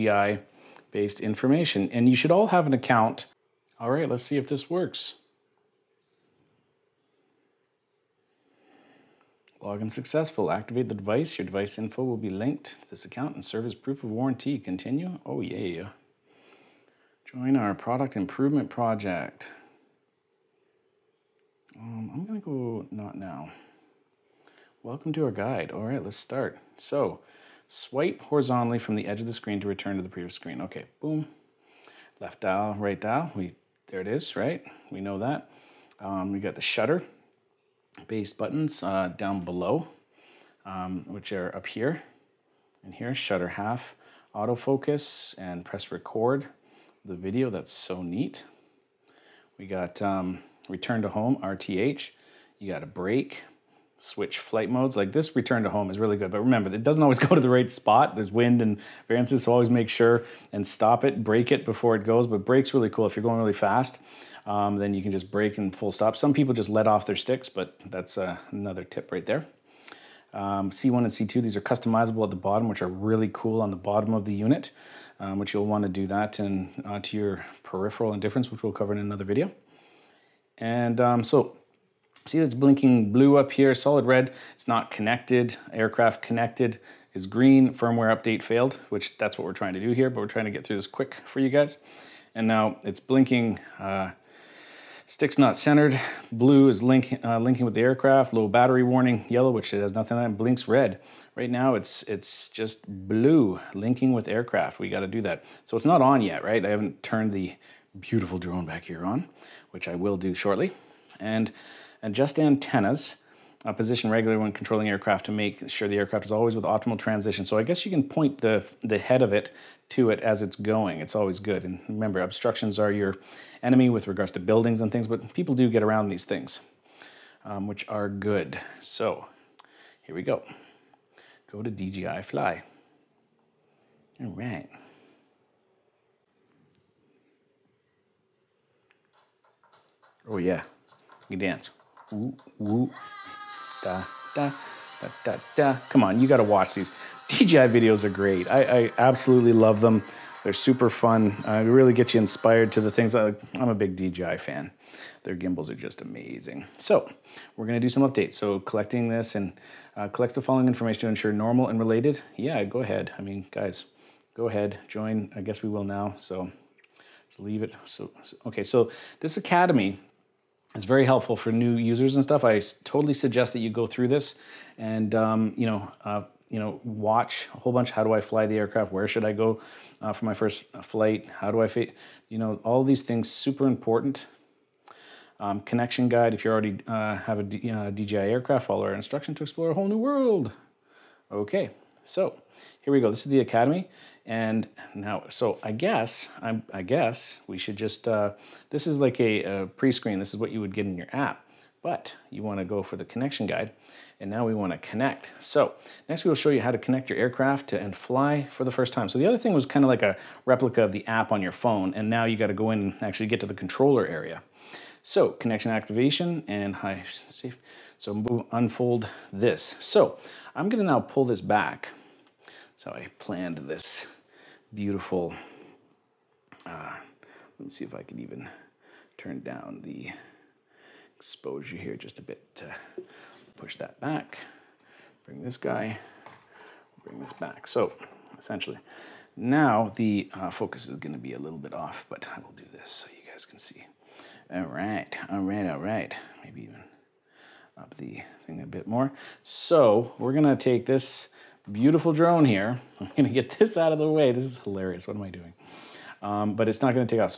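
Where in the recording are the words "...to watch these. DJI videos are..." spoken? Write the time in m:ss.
2:26.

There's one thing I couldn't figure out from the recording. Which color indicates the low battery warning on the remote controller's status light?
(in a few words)
Yellow.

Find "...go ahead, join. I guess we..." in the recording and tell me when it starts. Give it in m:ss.
2:44.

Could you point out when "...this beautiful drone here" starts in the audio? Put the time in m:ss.
4:10.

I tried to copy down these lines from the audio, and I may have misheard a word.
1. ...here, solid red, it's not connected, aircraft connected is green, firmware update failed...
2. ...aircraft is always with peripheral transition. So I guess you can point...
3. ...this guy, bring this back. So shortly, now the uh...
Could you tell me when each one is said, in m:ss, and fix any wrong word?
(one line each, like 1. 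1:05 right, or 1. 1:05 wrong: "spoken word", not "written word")
1. 1:23 right
2. 1:55 wrong: "optimal", not "peripheral"
3. 3:55 wrong: "essentially", not "shortly".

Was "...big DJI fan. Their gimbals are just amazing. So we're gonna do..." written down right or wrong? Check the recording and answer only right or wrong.
right.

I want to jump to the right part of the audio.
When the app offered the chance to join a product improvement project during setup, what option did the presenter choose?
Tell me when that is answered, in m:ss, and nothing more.
0:22.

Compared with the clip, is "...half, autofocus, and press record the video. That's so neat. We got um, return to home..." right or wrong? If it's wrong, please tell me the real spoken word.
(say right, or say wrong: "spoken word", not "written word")
right.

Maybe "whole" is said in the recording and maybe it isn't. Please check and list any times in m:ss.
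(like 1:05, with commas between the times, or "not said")
2:57, 3:09.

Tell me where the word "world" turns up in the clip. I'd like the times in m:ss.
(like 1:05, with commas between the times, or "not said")
3:09.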